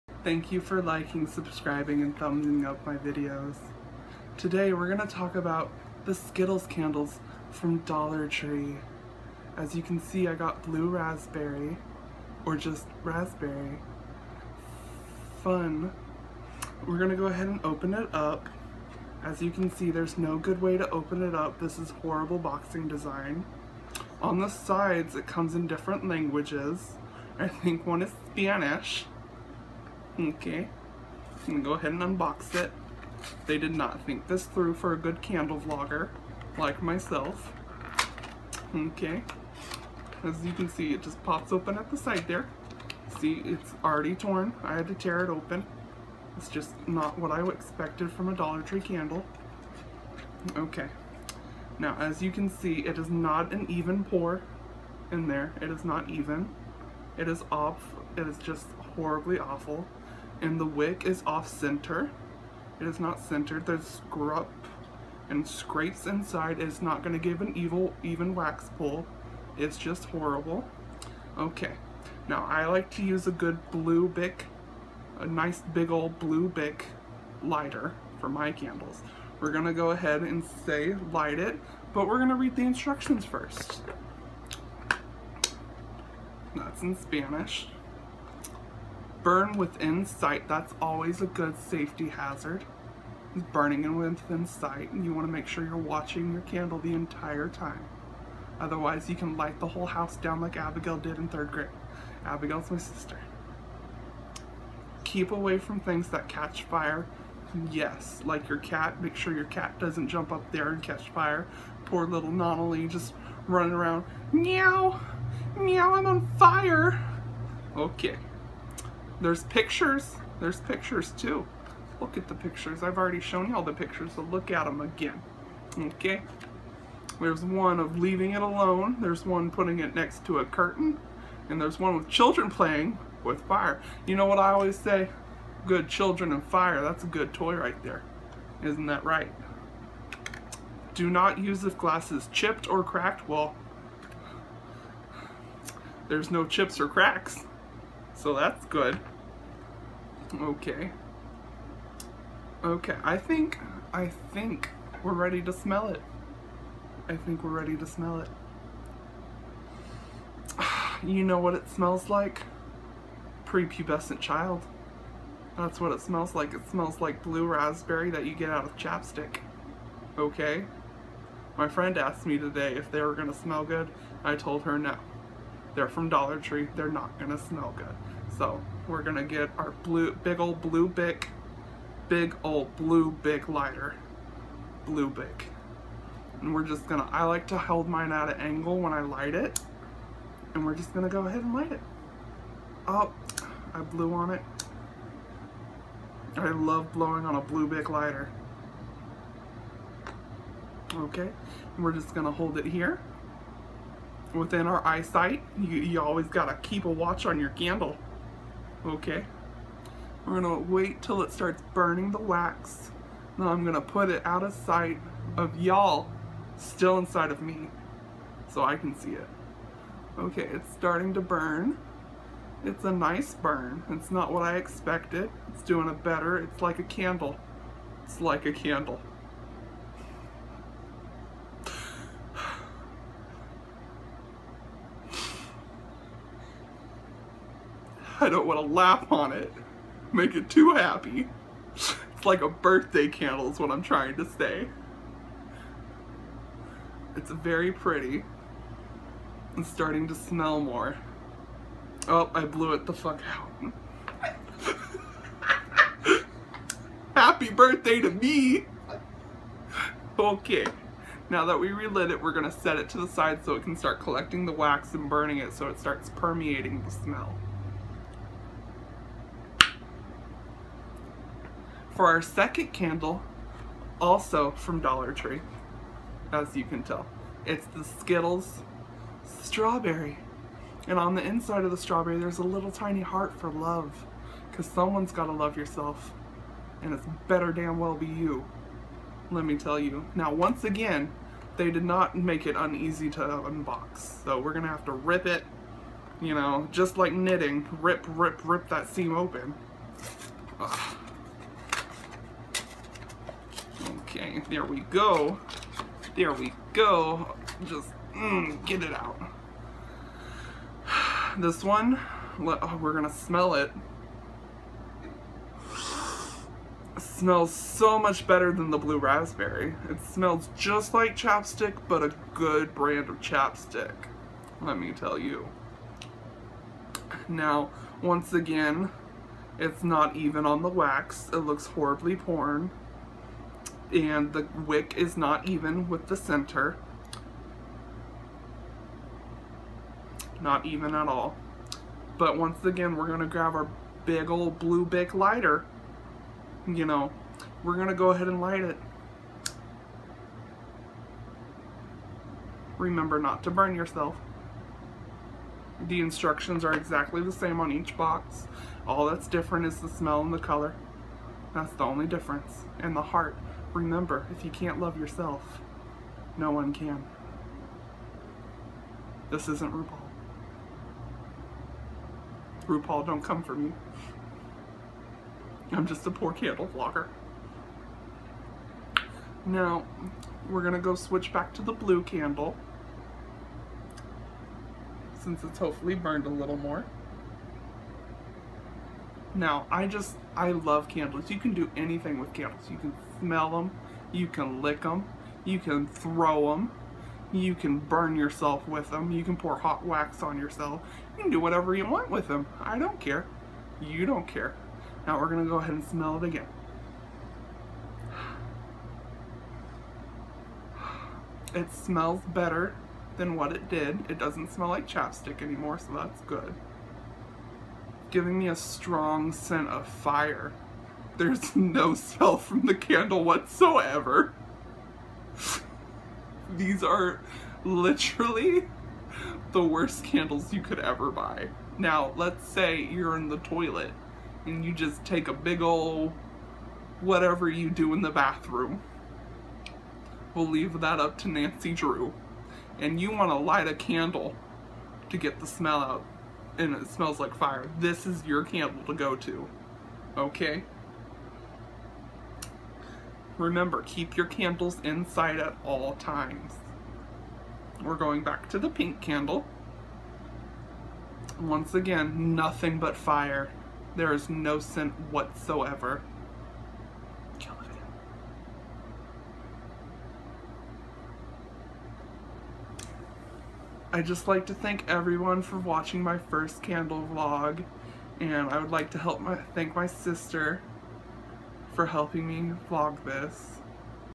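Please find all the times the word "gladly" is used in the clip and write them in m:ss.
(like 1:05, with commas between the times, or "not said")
not said.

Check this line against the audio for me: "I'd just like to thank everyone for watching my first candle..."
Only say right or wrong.
right.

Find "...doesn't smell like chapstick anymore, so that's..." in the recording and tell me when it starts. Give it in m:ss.
6:54.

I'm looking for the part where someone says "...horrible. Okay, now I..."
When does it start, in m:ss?
1:10.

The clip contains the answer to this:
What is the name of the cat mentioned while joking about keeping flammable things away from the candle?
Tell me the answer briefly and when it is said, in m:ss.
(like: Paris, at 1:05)
Nonalee, at 1:52.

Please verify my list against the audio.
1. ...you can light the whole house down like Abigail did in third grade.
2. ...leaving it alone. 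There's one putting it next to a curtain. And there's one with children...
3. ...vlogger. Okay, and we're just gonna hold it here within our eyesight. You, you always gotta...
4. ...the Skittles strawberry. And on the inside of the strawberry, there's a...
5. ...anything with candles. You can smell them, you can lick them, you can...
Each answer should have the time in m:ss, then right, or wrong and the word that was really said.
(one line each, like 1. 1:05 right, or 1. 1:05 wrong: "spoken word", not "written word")
1. 1:39 right
2. 2:07 right
3. 3:17 wrong: "lighter", not "vlogger"
4. 4:37 right
5. 6:31 right.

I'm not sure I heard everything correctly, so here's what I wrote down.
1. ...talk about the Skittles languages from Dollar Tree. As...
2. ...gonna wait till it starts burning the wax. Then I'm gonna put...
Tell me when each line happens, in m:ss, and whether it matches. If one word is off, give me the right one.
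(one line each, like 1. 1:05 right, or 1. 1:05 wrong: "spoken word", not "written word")
1. 0:05 wrong: "candles", not "languages"
2. 3:30 right.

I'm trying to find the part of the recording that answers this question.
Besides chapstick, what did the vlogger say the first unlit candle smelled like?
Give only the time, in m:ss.
2:43.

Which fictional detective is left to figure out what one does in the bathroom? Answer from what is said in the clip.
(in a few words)
Nancy Drew.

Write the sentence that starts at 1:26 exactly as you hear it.
That's in Spanish burn within sight.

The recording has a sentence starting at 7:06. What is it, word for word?
These are literally the worst candles you could ever buy.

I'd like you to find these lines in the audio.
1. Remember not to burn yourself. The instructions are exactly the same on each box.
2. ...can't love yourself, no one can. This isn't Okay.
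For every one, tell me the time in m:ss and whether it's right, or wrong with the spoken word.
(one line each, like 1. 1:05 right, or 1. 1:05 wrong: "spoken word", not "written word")
1. 5:52 right
2. 6:04 wrong: "RuPaul", not "Okay".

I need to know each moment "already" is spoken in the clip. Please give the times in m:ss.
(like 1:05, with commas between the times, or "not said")
0:43, 2:02.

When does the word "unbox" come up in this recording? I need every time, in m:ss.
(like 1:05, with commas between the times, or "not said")
0:32, 4:53.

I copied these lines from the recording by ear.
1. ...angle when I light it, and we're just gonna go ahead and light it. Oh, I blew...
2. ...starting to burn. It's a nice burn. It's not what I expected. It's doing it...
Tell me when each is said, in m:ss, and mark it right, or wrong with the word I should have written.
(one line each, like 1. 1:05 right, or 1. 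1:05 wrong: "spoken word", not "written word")
1. 3:08 right
2. 3:40 right.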